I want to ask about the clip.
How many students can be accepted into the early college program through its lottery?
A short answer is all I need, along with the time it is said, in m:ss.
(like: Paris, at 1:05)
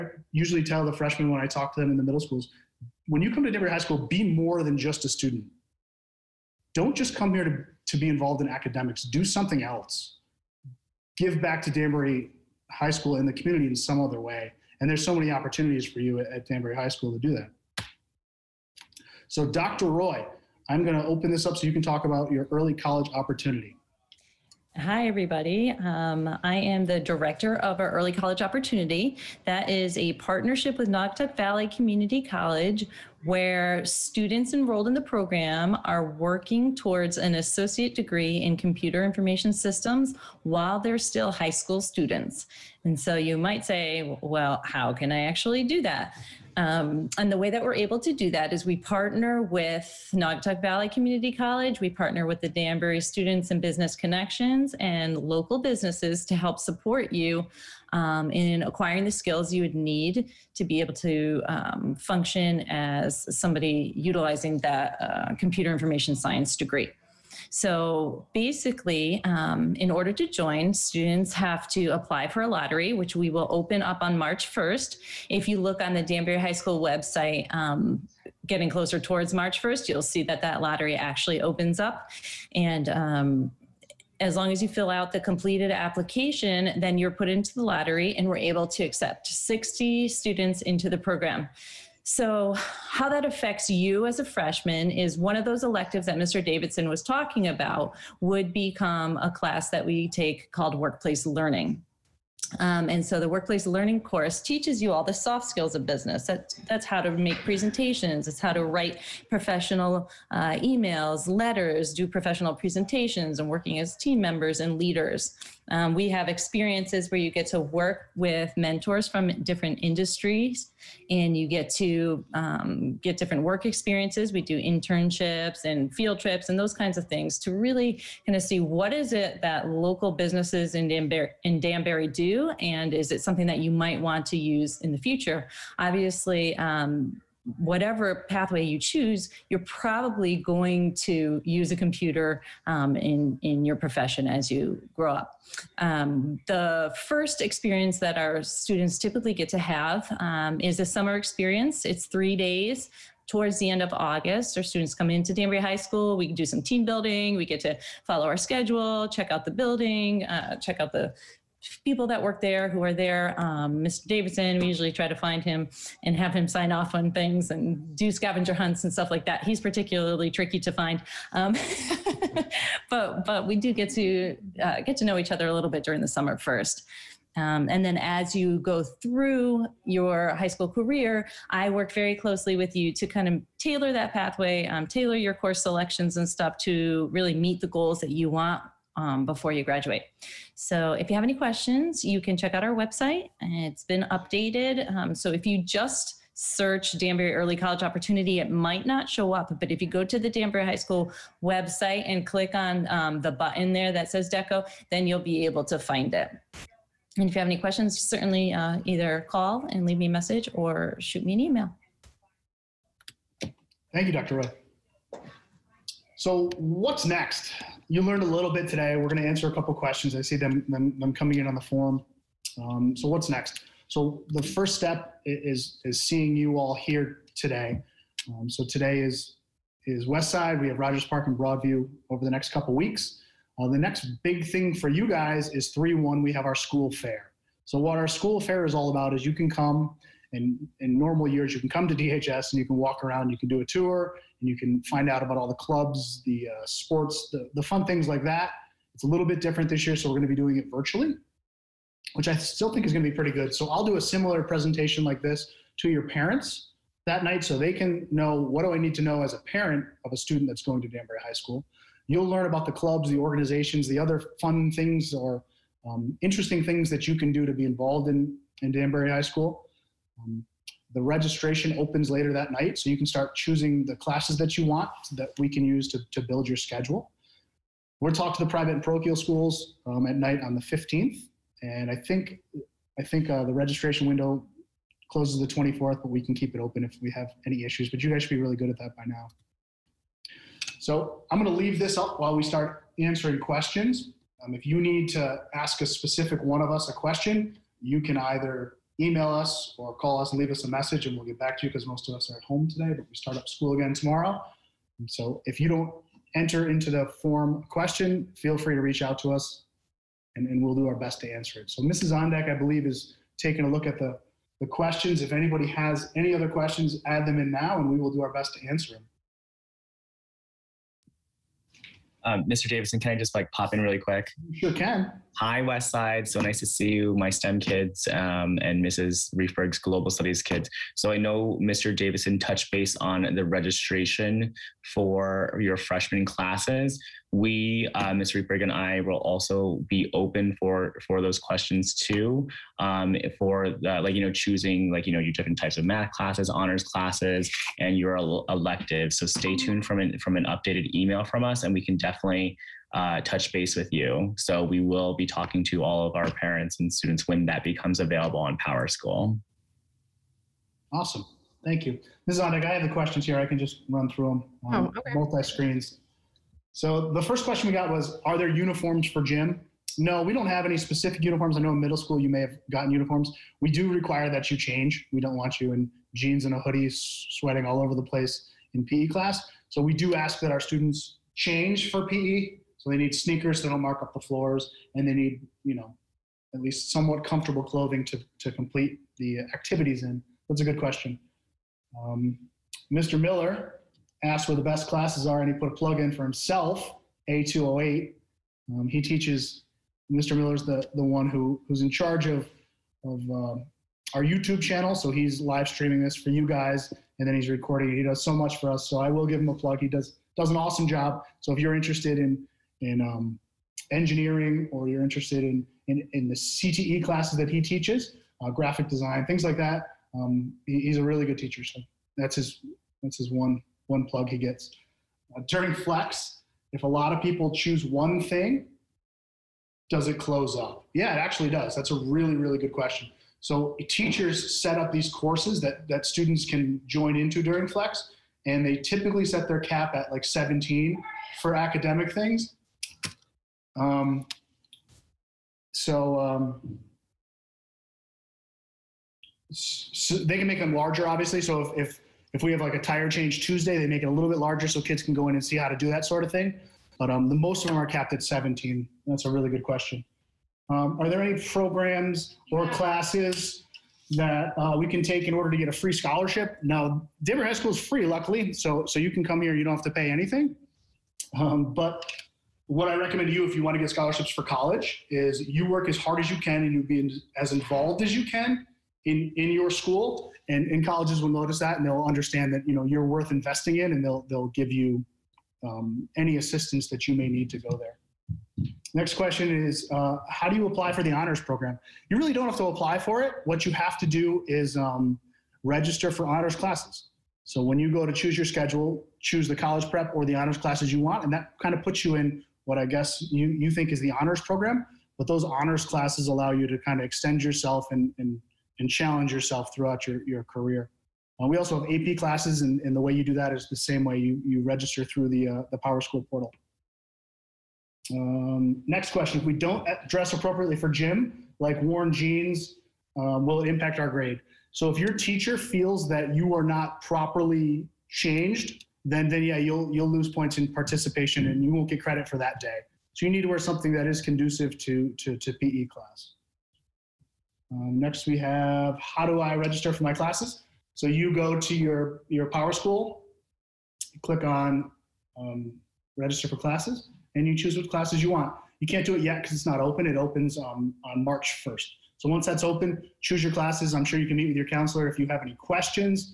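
60, at 1:29.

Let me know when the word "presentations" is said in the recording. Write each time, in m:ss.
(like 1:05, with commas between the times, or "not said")
1:47, 1:52, 4:14.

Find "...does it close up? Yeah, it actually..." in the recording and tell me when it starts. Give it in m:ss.
7:09.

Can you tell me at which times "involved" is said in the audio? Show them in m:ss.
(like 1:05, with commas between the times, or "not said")
0:08, 4:27, 7:57.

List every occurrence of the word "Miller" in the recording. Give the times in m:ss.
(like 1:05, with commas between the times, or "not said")
6:33, 6:40.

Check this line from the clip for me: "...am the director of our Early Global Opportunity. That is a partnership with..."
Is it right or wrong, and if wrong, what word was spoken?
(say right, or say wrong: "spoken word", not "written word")
wrong: "College", not "Global".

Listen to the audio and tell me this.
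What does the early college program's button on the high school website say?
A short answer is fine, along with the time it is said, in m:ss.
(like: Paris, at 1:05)
DECO, at 3:24.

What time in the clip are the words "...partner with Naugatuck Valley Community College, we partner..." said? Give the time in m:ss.
0:48.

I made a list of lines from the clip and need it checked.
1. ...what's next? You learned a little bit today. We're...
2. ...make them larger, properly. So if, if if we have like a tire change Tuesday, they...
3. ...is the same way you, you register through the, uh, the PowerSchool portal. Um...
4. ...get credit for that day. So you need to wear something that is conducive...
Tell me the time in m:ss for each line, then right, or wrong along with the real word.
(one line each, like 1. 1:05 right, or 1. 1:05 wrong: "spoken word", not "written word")
1. 3:36 right
2. 7:30 wrong: "obviously", not "properly"
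3. 8:33 right
4. 8:51 right.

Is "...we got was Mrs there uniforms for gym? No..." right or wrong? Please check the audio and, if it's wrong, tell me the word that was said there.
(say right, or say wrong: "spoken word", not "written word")
wrong: "Are", not "Mrs".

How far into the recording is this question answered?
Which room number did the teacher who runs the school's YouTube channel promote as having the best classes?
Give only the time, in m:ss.
6:37.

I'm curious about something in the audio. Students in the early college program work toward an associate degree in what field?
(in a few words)
Computer information systems.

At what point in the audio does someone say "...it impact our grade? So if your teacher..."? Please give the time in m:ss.
8:43.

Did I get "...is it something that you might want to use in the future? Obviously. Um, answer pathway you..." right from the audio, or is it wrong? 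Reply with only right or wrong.
wrong.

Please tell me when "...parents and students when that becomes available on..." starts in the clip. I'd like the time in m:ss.
5:56.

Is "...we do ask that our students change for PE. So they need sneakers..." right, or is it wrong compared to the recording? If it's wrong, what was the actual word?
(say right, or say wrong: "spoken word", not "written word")
right.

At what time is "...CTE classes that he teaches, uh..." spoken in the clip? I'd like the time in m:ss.
6:56.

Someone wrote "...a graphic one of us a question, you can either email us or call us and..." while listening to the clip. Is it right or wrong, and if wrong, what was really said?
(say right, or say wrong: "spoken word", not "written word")
wrong: "specific", not "graphic".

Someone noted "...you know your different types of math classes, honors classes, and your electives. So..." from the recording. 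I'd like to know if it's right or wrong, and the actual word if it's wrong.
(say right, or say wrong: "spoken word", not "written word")
right.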